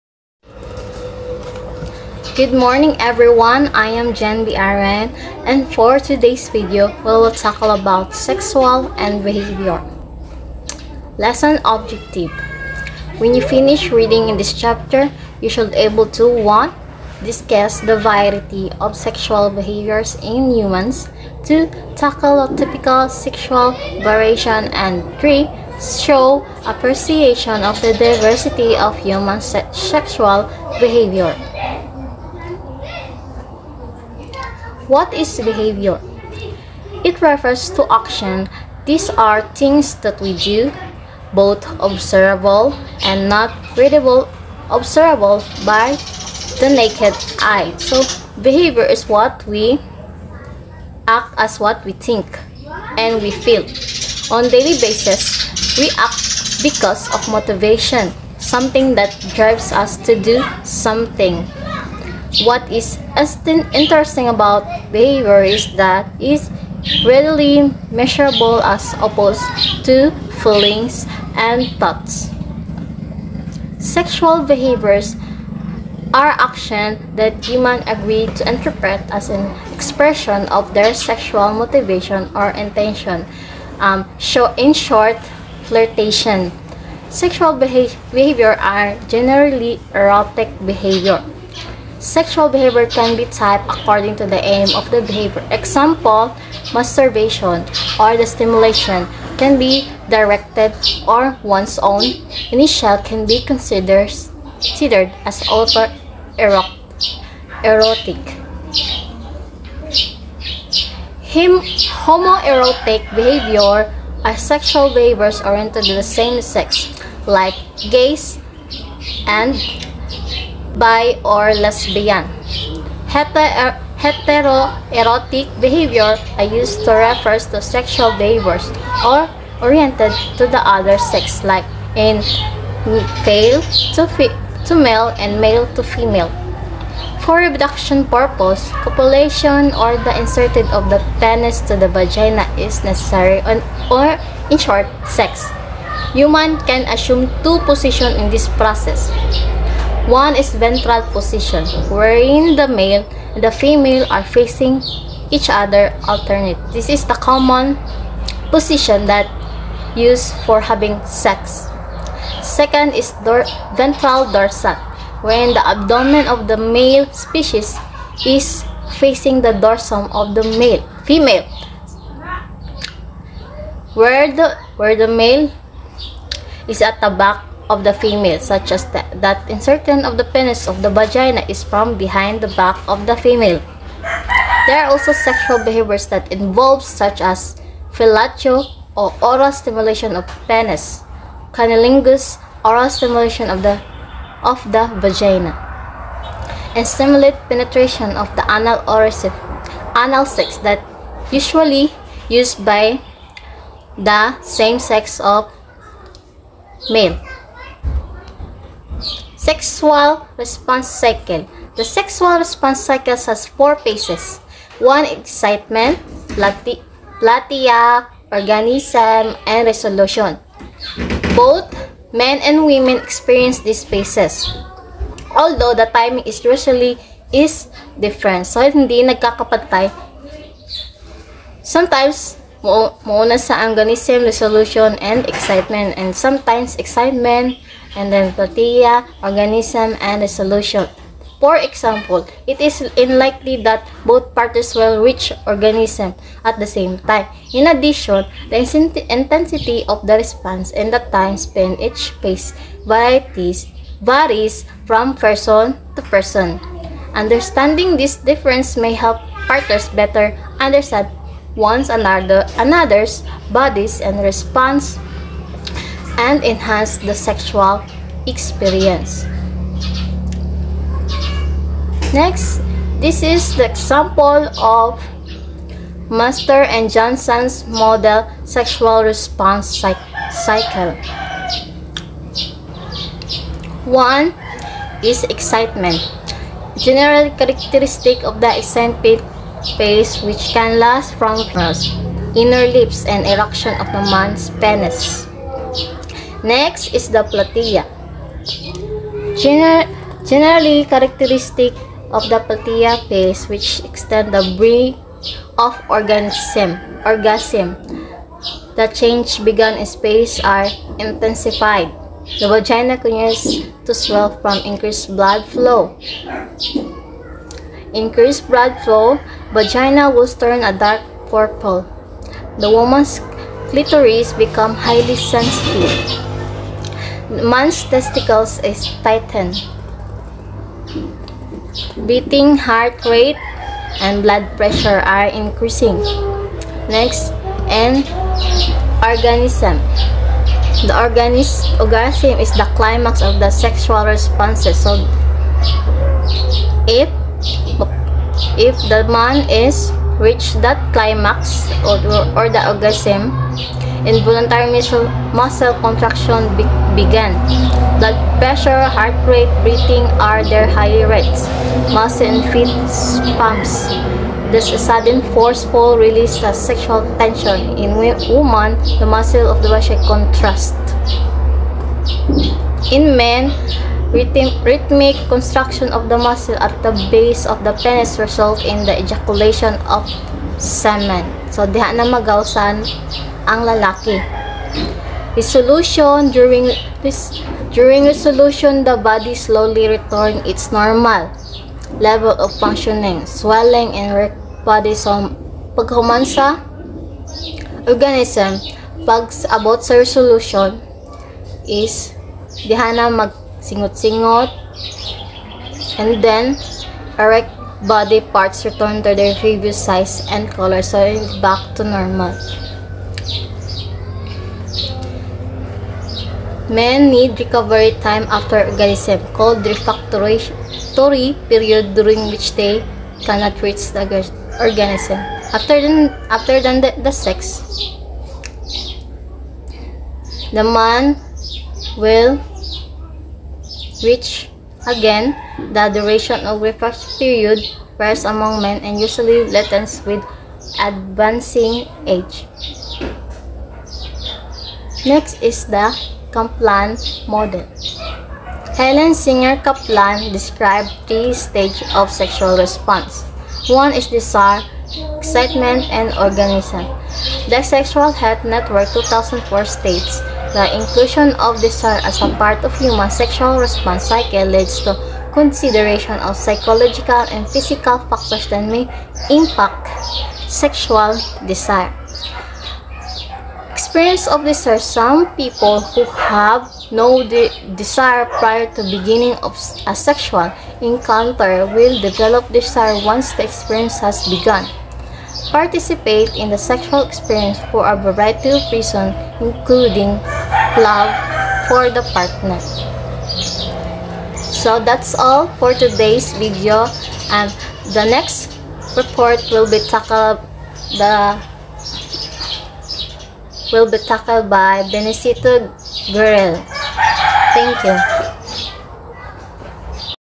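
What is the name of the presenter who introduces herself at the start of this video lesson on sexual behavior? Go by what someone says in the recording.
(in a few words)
Jen B.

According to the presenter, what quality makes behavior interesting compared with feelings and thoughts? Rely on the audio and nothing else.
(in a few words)
readily measurable.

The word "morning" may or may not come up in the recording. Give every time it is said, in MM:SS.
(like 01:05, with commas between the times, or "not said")
00:02.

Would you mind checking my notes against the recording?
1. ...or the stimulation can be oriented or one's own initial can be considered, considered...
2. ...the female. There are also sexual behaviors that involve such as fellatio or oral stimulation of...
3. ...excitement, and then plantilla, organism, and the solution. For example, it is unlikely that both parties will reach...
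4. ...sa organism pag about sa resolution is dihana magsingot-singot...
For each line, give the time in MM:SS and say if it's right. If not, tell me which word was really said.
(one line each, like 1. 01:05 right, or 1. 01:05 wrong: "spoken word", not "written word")
1. 01:37 wrong: "directed", not "oriented"
2. 03:03 right
3. 03:56 right
4. 06:36 right.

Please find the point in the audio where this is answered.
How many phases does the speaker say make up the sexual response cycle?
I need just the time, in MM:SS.
03:33.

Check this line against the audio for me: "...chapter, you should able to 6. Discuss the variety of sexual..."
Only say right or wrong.
wrong.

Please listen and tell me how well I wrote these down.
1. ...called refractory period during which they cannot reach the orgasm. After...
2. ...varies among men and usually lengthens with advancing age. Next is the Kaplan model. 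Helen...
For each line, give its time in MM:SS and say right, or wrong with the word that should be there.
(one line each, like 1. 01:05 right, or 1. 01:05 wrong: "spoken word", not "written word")
1. 06:59 right
2. 07:17 right.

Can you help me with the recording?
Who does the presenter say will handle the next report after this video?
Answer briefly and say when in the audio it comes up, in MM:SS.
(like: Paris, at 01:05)
Benecito Guerrero, at 08:24.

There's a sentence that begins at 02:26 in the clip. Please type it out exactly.
Human can assume two positions in this process.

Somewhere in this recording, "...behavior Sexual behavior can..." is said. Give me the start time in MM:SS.
01:30.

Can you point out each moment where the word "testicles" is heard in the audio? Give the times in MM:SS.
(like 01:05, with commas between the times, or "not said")
05:27.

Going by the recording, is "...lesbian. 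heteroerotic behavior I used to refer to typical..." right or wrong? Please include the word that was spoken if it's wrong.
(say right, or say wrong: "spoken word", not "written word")
wrong: "sexual", not "typical".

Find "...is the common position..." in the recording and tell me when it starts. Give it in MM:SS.
02:36.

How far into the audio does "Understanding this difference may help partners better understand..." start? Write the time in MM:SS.
04:17.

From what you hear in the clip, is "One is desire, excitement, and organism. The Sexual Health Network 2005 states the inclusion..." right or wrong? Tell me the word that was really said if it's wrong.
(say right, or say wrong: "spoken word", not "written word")
wrong: "2004", not "2005".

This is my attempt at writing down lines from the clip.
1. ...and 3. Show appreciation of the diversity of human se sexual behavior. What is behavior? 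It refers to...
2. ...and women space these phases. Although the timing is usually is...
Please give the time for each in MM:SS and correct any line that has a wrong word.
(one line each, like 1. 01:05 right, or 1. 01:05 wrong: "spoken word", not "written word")
1. 00:24 right
2. 03:42 wrong: "experience", not "space".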